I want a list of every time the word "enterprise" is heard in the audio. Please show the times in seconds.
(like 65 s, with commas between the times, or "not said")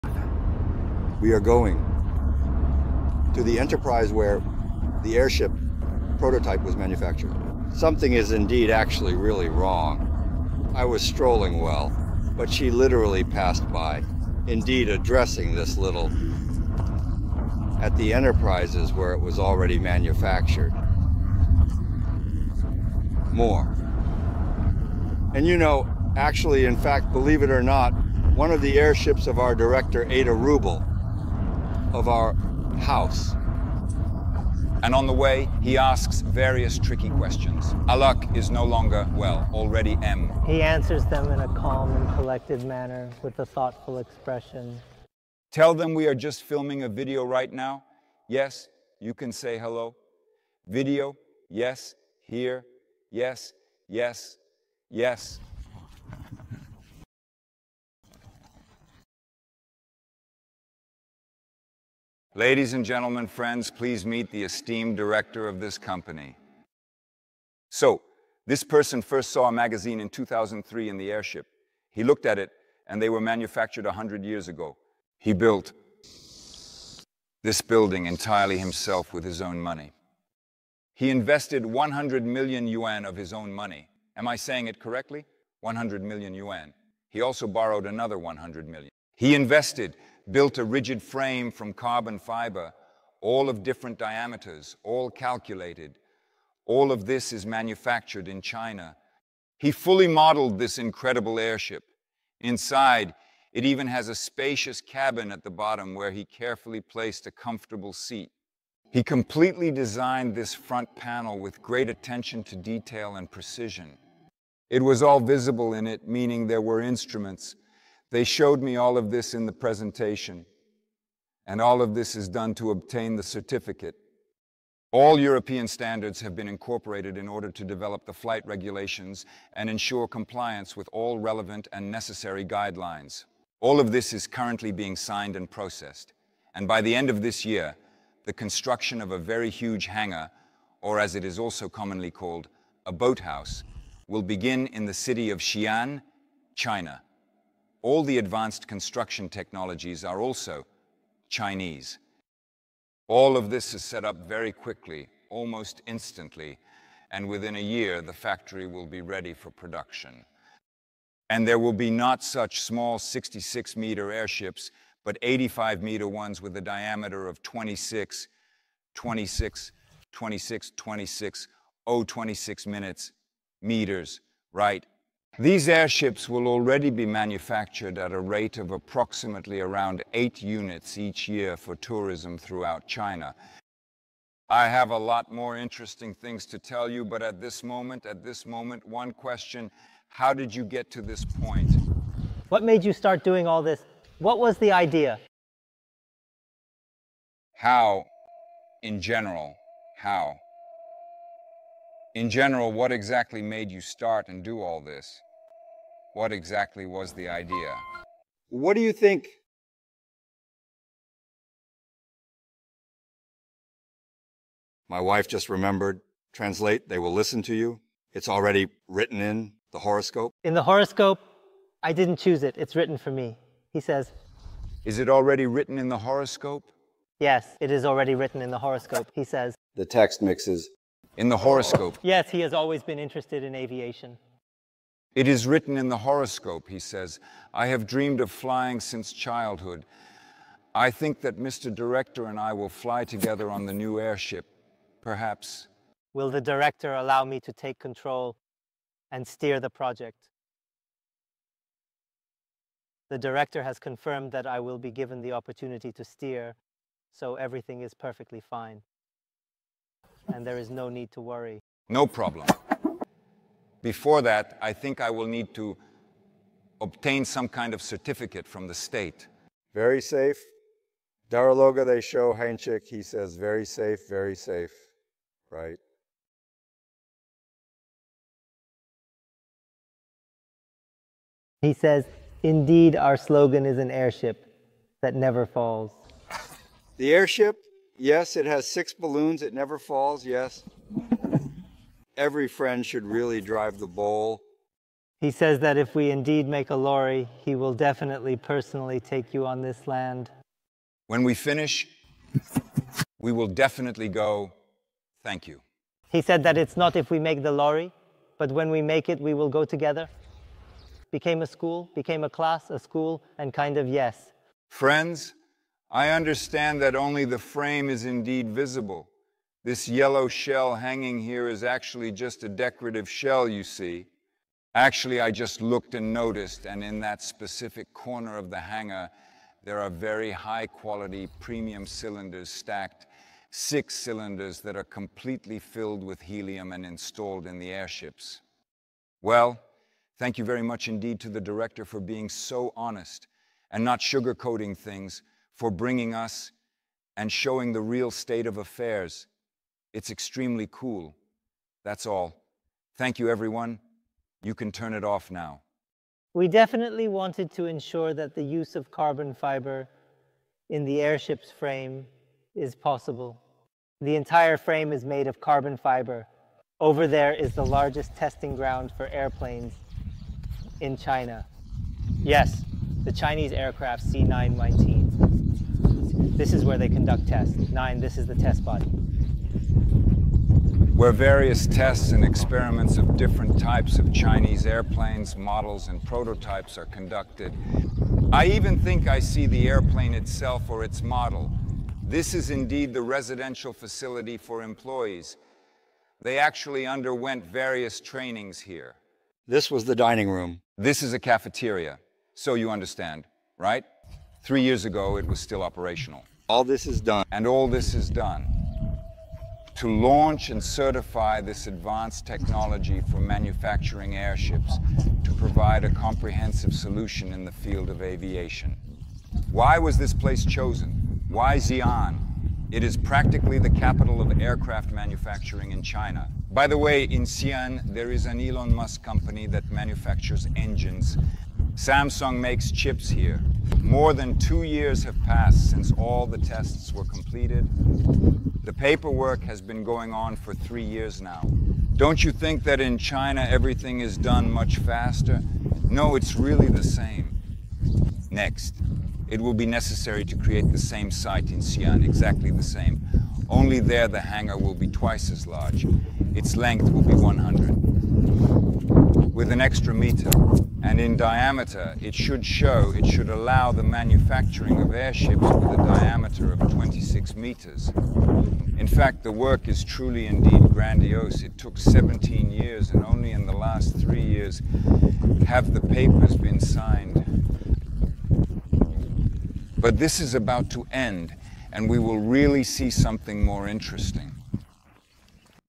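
3 s, 18 s.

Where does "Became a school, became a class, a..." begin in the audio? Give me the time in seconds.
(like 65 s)
311 s.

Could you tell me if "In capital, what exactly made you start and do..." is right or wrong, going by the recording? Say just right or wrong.
wrong.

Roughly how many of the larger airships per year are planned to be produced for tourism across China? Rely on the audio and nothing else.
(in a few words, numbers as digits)
8.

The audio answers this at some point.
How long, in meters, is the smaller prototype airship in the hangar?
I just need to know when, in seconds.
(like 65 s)
162 s.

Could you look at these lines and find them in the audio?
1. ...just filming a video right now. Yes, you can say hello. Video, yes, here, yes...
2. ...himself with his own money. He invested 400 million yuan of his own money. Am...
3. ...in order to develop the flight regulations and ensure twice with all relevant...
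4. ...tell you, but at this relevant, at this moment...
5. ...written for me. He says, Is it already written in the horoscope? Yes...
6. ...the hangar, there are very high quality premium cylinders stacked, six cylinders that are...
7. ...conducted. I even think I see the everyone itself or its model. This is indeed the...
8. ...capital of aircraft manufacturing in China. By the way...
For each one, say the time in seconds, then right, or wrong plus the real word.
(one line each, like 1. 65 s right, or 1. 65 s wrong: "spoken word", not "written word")
1. 46 s right
2. 78 s wrong: "100", not "400"
3. 127 s wrong: "compliance", not "twice"
4. 186 s wrong: "moment", not "relevant"
5. 222 s right
6. 328 s right
7. 386 s wrong: "airplane", not "everyone"
8. 423 s right.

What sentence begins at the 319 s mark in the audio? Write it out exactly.
This yellow shell hanging here is actually just a decorative shell, you see.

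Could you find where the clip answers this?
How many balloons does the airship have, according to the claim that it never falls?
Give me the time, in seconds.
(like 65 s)
288 s.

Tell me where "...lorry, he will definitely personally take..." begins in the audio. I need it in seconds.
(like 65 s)
296 s.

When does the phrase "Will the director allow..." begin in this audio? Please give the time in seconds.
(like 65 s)
246 s.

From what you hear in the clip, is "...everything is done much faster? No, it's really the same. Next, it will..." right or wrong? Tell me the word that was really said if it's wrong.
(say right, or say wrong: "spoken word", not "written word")
right.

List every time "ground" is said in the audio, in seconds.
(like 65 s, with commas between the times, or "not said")
368 s.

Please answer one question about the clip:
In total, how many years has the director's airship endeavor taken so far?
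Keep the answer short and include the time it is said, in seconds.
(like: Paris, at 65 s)
17 years, at 471 s.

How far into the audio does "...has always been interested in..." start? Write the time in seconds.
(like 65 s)
232 s.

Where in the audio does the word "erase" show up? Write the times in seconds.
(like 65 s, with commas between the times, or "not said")
not said.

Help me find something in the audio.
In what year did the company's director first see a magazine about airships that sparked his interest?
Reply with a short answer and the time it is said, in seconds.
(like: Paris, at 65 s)
2003, at 70 s.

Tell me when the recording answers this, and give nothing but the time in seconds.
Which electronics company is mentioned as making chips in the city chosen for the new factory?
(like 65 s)
431 s.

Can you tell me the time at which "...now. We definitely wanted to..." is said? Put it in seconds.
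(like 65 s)
355 s.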